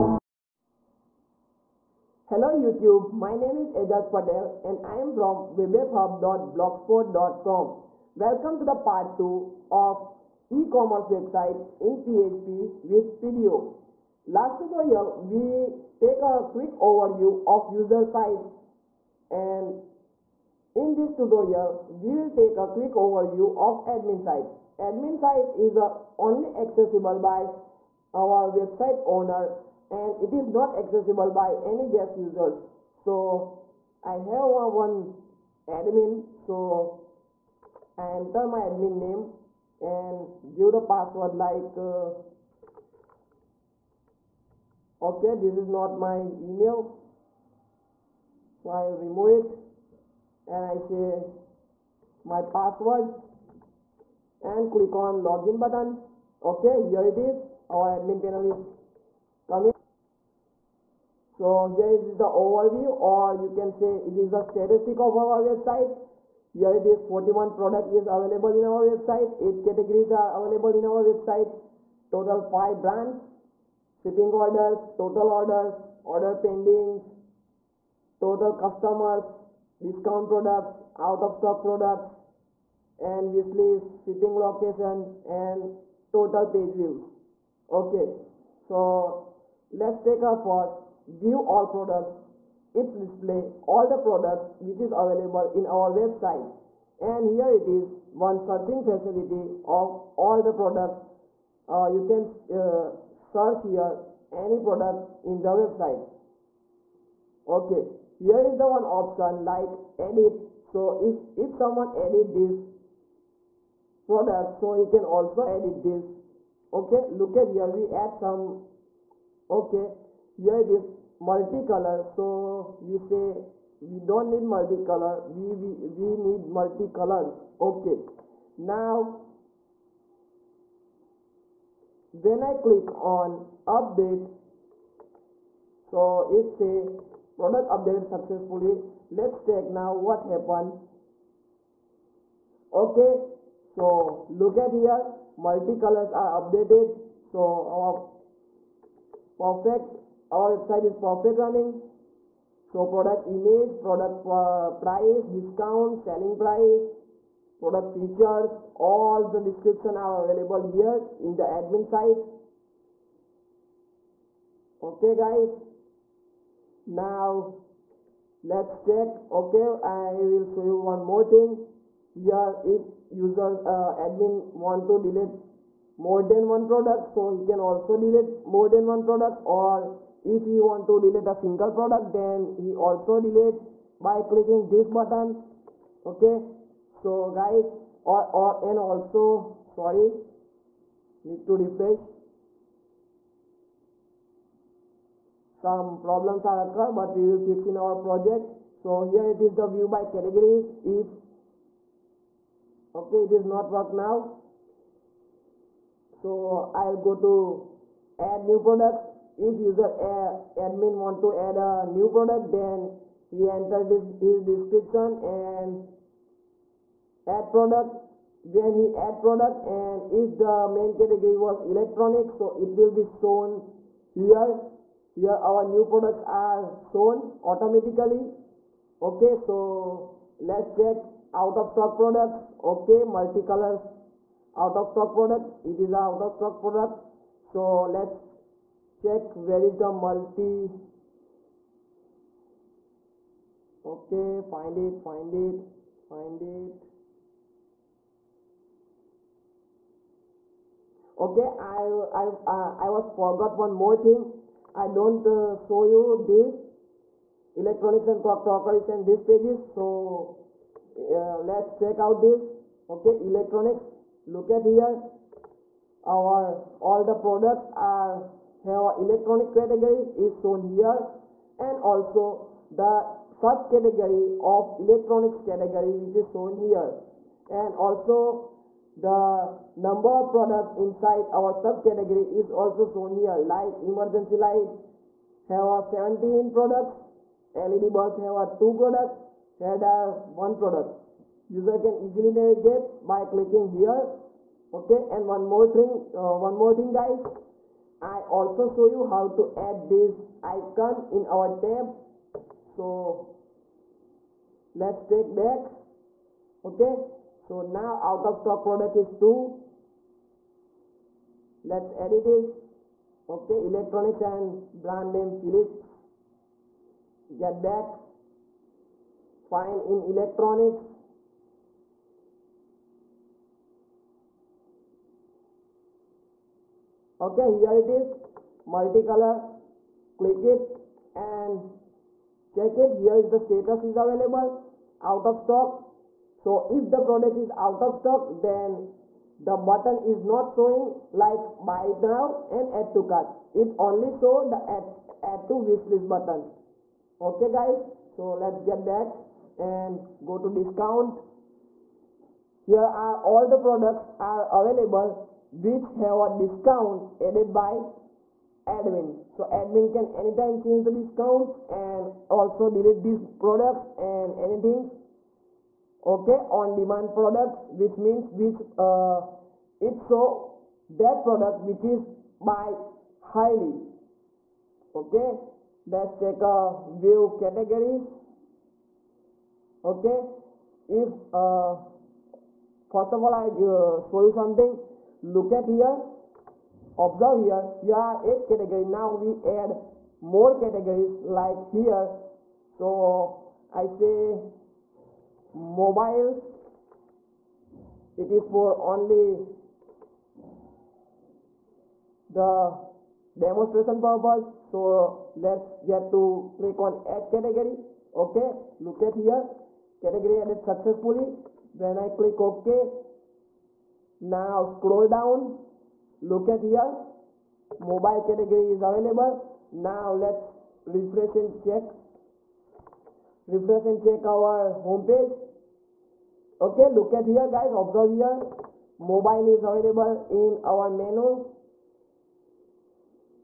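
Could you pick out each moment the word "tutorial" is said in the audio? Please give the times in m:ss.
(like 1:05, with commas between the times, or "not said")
0:14, 0:21.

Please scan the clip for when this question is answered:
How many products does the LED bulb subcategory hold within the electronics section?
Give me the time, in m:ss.
4:47.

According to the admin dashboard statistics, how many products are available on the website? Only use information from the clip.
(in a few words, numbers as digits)
41.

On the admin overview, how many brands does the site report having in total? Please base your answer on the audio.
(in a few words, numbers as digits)
5.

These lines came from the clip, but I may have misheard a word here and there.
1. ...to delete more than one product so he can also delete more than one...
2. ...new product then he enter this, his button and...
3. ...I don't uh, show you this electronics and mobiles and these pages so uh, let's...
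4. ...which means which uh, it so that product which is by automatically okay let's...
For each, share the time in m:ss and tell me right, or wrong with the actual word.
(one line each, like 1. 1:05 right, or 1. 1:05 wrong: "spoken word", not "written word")
1. 2:54 right
2. 3:31 wrong: "description", not "button"
3. 4:14 wrong: "crockeries", not "mobiles"
4. 6:07 wrong: "highly", not "automatically".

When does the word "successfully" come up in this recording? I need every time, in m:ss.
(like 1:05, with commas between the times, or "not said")
2:18, 6:50.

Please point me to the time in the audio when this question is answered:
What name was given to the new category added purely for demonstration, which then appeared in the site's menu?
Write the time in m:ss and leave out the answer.
6:35.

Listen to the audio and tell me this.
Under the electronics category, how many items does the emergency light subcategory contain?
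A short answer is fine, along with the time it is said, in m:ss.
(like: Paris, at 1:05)
17, at 4:43.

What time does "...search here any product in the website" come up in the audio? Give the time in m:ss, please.
1:43.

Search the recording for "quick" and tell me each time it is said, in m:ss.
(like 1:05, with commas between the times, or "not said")
0:16, 0:22.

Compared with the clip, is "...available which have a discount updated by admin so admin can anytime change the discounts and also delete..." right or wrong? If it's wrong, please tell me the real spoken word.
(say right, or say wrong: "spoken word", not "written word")
wrong: "added", not "updated".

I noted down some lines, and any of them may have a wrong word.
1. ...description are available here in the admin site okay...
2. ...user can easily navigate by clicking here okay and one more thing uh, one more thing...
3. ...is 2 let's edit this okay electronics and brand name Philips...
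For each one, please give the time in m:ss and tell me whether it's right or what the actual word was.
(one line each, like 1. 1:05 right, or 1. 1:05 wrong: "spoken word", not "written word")
1. 2:39 right
2. 4:51 right
3. 5:08 right.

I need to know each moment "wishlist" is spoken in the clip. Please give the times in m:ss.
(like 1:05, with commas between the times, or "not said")
1:23, 5:45.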